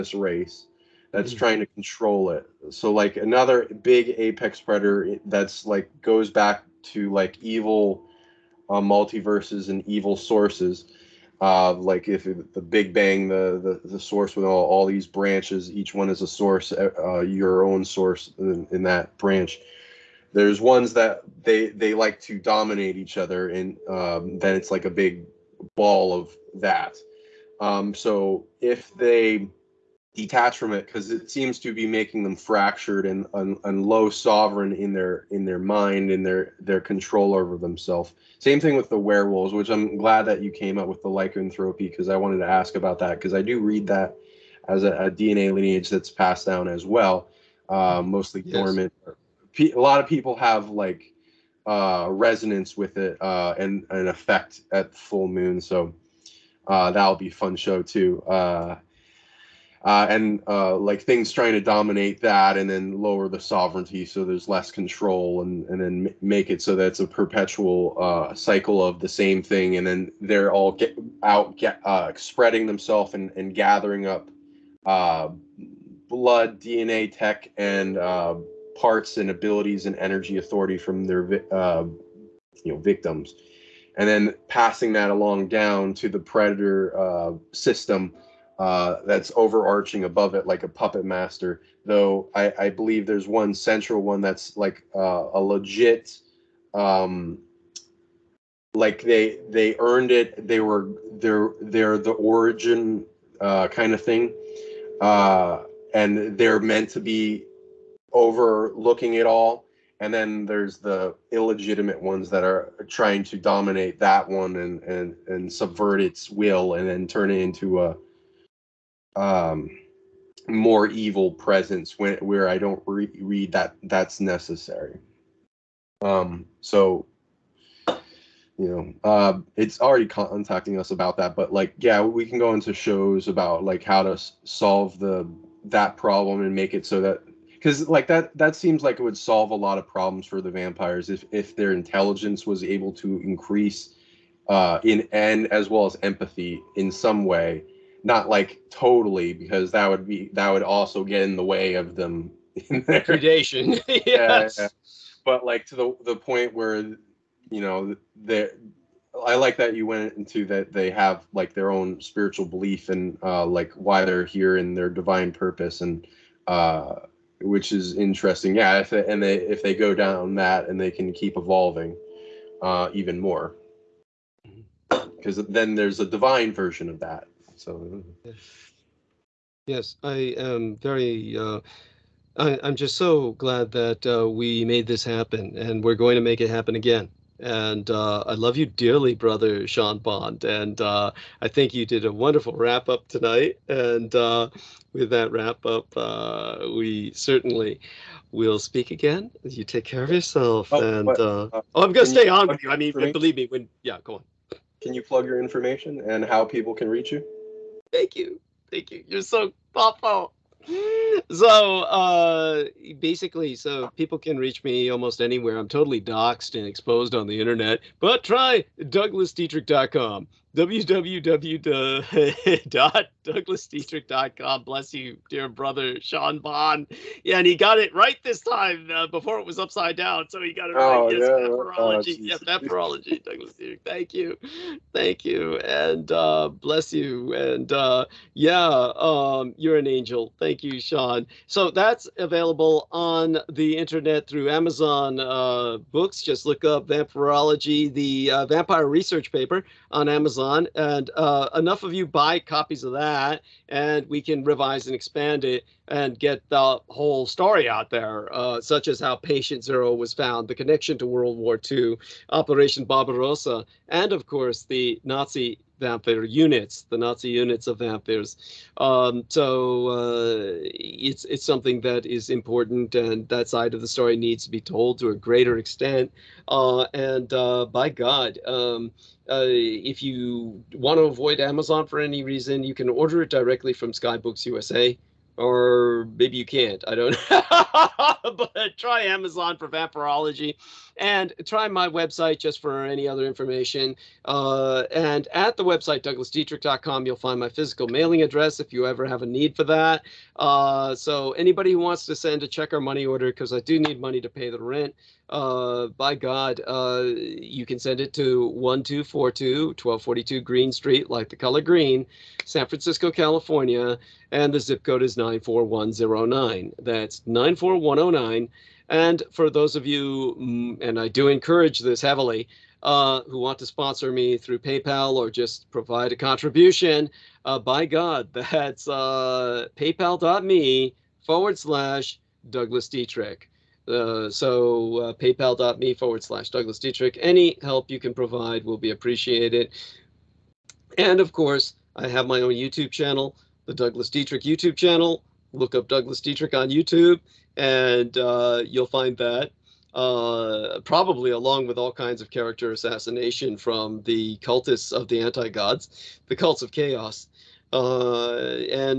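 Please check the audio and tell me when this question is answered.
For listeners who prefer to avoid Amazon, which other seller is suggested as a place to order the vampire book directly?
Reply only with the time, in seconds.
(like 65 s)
283 s.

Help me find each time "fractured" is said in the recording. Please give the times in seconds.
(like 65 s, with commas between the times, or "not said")
32 s.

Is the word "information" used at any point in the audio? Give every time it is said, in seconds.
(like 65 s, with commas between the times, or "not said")
205 s, 293 s.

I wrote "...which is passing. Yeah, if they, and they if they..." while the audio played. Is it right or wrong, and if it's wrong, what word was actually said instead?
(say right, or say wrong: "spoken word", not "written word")
wrong: "interesting", not "passing".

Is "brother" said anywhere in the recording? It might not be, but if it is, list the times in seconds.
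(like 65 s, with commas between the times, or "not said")
189 s, 225 s.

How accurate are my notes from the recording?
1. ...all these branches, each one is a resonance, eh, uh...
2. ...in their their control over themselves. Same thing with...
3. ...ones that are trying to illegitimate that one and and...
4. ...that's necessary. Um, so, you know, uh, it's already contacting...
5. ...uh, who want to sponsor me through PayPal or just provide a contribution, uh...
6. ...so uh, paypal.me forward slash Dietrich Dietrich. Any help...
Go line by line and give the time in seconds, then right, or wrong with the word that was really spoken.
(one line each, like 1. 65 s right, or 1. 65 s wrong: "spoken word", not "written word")
1. 14 s wrong: "source", not "resonance"
2. 36 s right
3. 112 s wrong: "dominate", not "illegitimate"
4. 123 s right
5. 322 s right
6. 334 s wrong: "Douglas", not "Dietrich".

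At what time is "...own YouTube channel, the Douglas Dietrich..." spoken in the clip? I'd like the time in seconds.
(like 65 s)
342 s.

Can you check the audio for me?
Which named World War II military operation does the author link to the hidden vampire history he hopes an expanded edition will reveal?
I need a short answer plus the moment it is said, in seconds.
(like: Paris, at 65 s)
Operation Barbarossa, at 262 s.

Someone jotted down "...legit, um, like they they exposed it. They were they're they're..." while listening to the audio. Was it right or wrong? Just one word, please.
wrong.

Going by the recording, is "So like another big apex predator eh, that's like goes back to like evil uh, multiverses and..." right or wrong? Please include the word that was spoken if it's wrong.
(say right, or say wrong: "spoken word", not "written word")
right.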